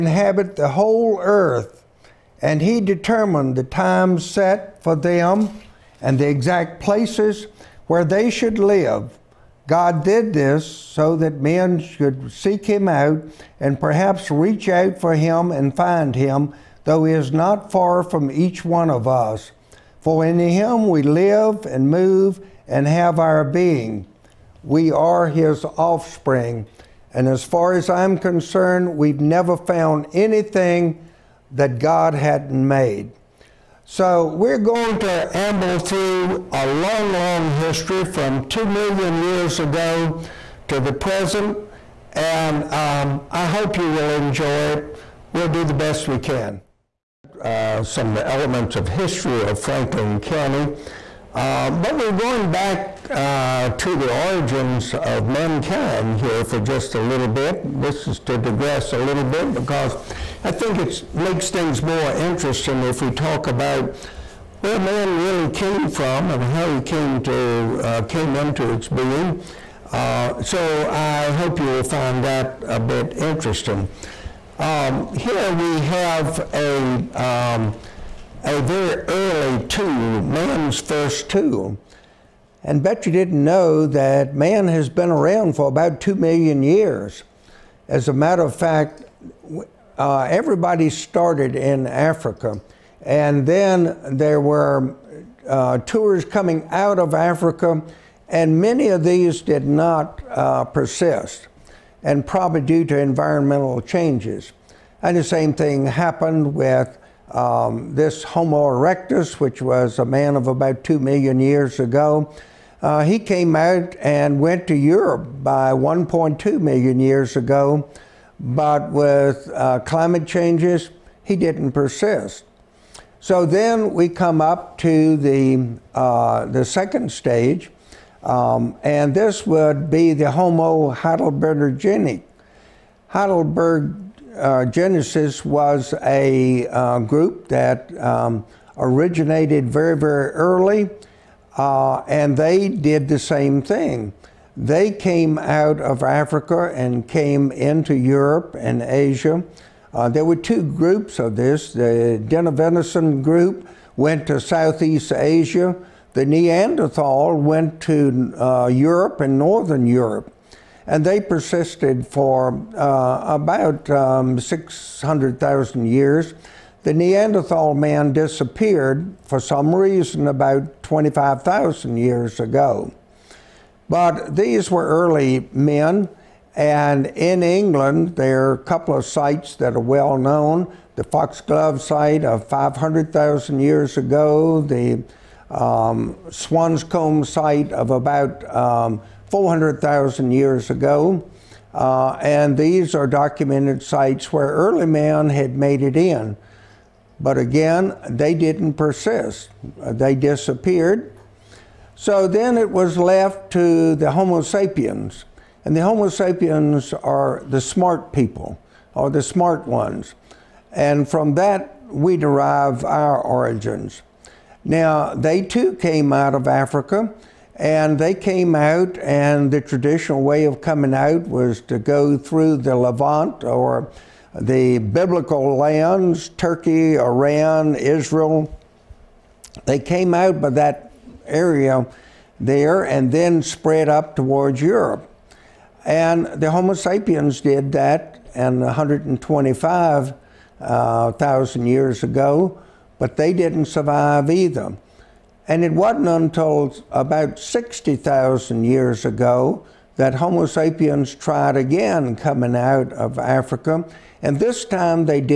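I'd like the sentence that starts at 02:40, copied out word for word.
And they persisted for uh, about um, 600,000 years.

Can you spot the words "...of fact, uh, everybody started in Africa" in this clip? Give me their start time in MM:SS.
01:28.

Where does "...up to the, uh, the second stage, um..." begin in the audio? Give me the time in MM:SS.
02:04.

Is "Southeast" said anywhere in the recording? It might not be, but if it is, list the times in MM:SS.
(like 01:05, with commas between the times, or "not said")
02:34.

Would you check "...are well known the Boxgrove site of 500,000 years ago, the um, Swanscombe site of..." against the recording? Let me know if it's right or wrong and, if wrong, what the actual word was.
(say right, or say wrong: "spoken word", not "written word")
right.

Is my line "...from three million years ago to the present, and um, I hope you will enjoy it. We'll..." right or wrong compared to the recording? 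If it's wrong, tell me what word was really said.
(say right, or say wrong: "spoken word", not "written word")
wrong: "two", not "three".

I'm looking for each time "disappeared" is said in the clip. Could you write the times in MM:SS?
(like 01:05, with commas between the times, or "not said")
02:48, 03:20.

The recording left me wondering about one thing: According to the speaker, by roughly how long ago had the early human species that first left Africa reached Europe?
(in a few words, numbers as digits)
1.2 million years ago.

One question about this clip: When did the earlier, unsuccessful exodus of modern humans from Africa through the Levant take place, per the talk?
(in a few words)
125,000 years ago.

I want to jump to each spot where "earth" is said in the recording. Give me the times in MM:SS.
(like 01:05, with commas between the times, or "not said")
00:01.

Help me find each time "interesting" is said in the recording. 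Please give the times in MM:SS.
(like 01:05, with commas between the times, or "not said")
01:02, 01:13.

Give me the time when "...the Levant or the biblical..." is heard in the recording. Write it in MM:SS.
03:42.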